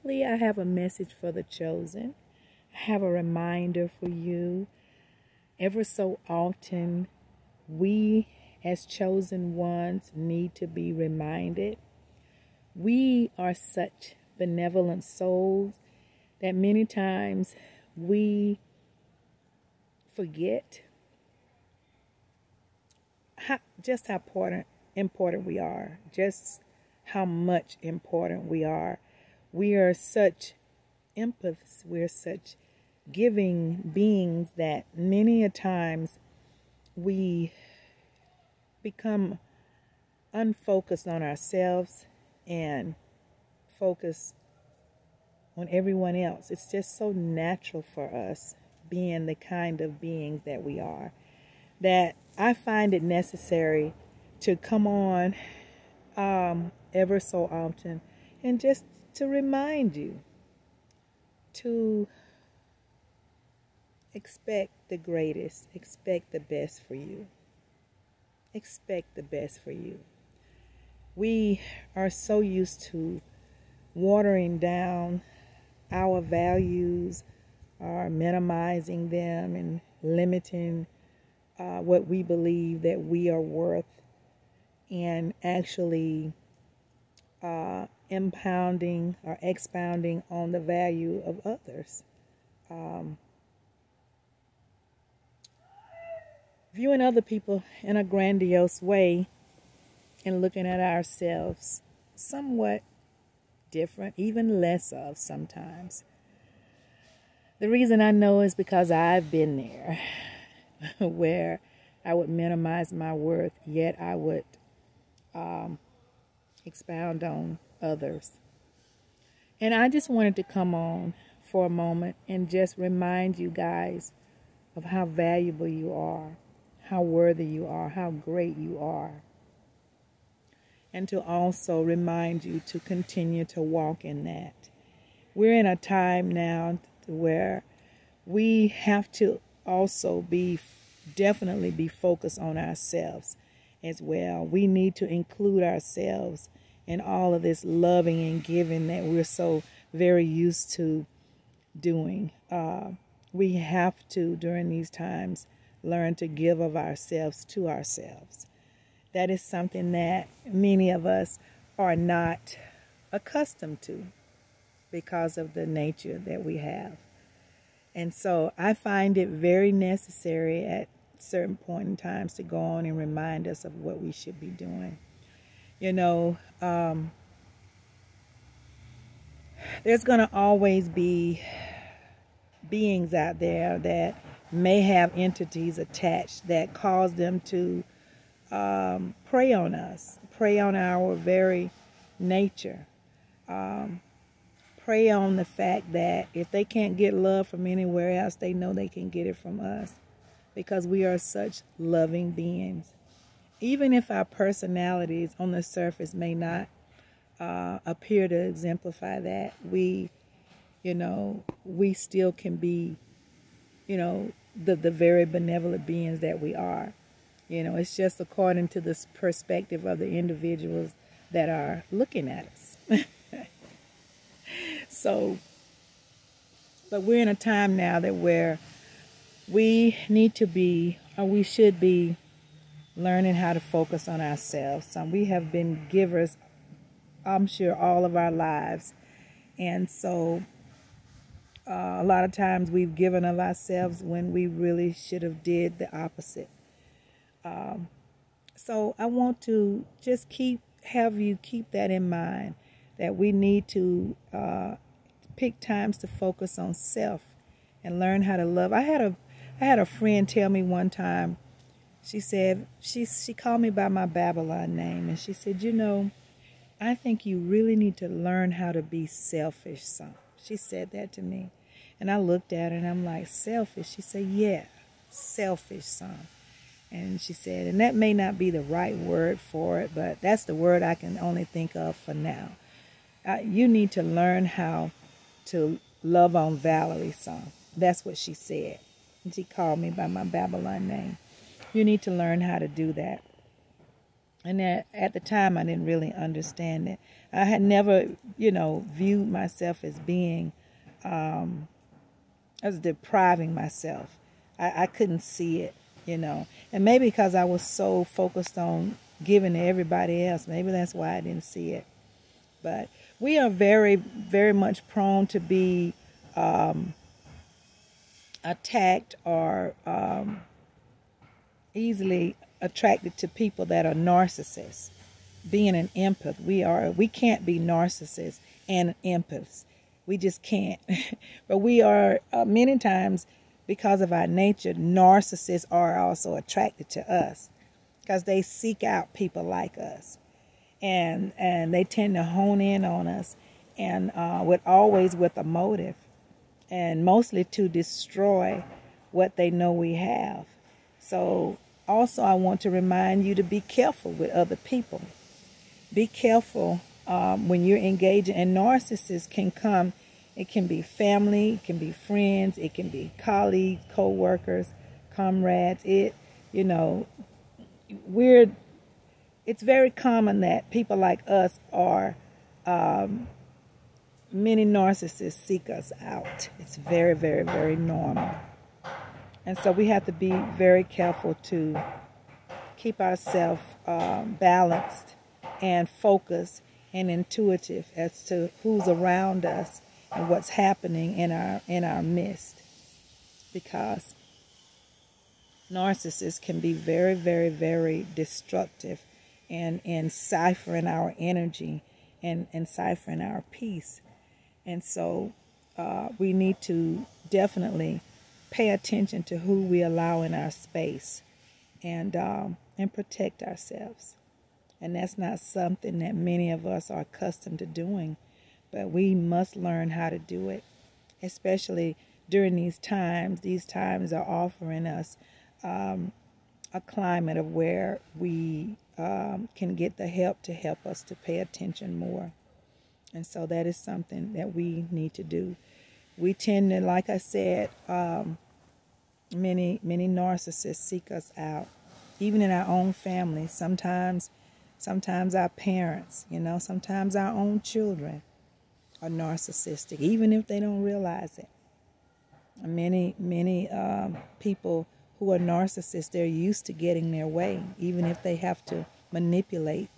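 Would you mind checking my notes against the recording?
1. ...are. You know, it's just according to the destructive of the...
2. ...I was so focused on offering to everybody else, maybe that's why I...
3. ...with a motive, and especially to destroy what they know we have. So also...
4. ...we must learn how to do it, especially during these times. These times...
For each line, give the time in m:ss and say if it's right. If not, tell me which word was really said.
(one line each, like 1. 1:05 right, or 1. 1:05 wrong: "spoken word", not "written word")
1. 3:36 wrong: "perspective", not "destructive"
2. 5:07 wrong: "giving", not "offering"
3. 5:45 wrong: "mostly", not "especially"
4. 6:58 right.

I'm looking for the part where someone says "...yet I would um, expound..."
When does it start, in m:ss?
1:53.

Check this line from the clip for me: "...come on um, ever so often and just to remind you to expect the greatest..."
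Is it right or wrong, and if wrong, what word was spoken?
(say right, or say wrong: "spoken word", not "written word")
right.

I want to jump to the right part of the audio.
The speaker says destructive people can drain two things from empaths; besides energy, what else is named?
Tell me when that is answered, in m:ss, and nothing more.
6:43.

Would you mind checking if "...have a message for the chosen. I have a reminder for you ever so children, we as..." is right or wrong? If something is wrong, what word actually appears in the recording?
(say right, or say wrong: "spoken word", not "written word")
wrong: "often", not "children".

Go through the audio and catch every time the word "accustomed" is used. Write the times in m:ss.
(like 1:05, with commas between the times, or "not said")
2:43, 6:57.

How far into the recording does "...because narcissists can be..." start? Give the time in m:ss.
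6:33.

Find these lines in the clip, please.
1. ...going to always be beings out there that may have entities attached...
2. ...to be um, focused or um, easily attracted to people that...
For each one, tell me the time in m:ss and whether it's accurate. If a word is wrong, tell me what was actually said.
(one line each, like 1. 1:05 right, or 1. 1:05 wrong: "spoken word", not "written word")
1. 3:00 right
2. 5:15 wrong: "attacked", not "focused".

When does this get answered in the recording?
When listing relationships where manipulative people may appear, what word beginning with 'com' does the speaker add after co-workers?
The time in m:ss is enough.
6:05.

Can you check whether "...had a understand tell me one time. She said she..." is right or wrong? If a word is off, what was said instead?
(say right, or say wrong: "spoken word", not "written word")
wrong: "friend", not "understand".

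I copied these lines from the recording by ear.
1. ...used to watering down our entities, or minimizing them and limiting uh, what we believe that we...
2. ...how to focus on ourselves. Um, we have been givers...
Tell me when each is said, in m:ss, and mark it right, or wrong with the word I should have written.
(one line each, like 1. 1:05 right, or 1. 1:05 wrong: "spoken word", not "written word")
1. 1:12 wrong: "values", not "entities"
2. 3:53 right.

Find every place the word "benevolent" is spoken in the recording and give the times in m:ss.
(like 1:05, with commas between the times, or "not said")
0:14, 3:35.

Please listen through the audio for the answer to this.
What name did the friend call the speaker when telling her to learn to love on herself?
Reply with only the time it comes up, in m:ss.
4:46.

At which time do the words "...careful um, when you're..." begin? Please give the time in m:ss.
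5:56.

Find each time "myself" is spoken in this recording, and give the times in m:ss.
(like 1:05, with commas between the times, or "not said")
4:59, 5:03.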